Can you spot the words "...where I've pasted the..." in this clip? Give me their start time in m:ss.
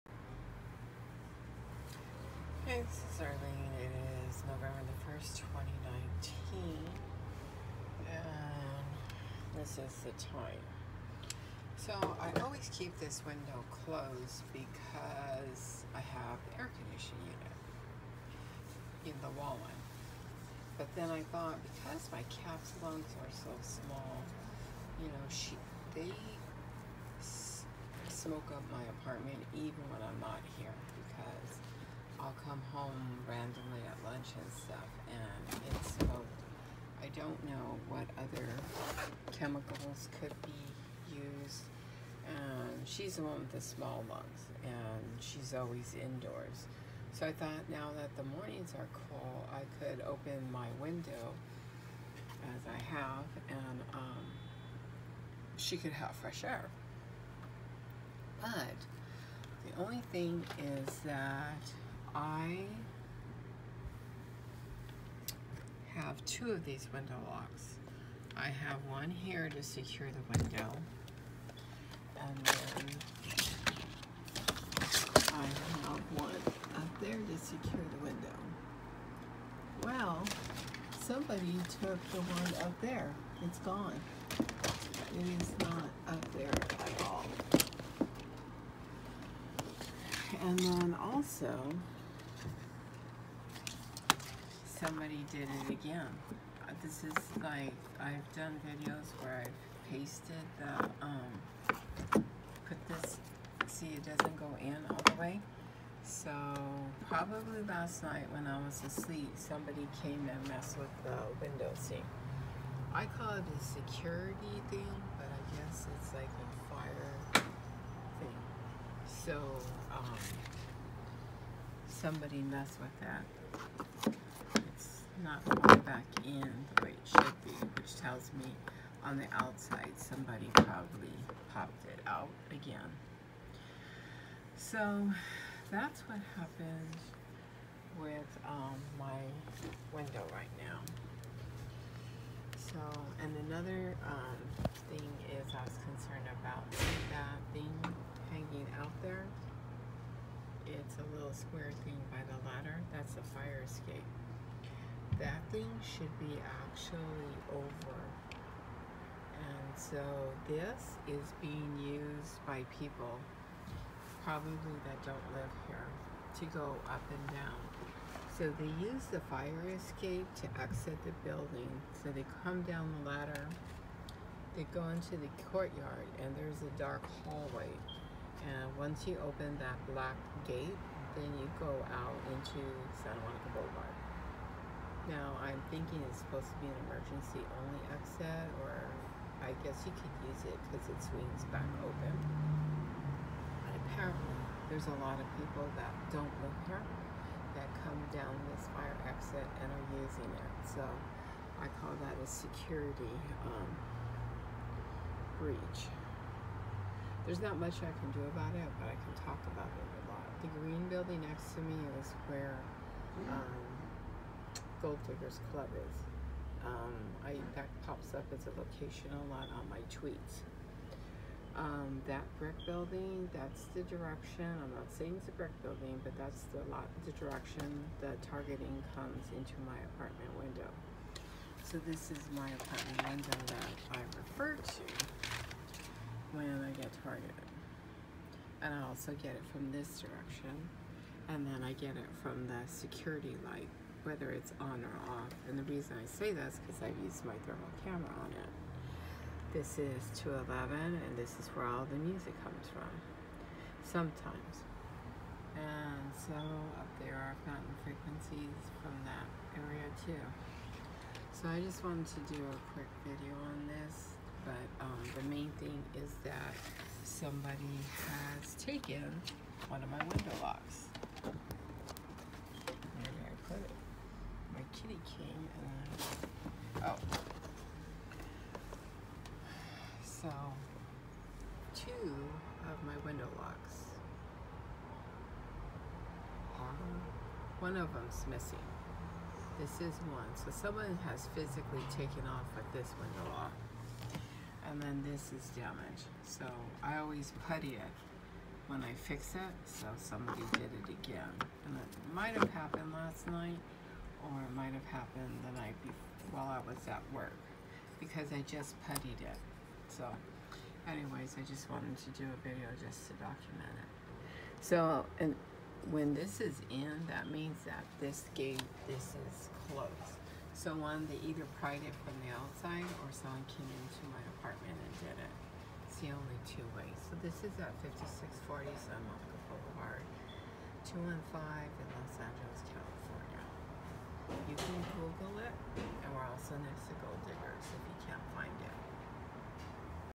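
1:39.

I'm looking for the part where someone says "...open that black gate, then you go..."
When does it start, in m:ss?
2:59.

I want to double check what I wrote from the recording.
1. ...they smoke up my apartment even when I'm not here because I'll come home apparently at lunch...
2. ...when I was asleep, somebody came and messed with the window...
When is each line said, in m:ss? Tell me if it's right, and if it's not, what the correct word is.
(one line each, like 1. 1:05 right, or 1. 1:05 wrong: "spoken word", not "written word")
1. 0:25 wrong: "randomly", not "apparently"
2. 1:48 right.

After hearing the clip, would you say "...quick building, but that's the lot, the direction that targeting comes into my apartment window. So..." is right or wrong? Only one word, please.
wrong.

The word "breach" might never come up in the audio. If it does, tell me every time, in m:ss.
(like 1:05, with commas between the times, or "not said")
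3:25.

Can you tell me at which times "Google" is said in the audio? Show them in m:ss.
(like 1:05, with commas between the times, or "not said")
5:34.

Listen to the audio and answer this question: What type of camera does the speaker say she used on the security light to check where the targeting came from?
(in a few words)
Thermal camera.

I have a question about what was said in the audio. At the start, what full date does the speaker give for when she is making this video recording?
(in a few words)
November 1, 2019.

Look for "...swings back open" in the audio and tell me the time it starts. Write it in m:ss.
3:11.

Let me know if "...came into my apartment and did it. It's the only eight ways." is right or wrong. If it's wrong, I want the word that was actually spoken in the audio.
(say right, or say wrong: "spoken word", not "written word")
wrong: "two", not "eight".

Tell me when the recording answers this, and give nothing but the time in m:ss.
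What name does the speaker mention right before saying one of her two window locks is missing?
4:34.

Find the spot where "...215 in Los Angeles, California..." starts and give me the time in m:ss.
5:30.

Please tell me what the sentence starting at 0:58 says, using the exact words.
But the only thing is that I have two of these window locks.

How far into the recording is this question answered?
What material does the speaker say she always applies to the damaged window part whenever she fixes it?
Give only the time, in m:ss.
4:57.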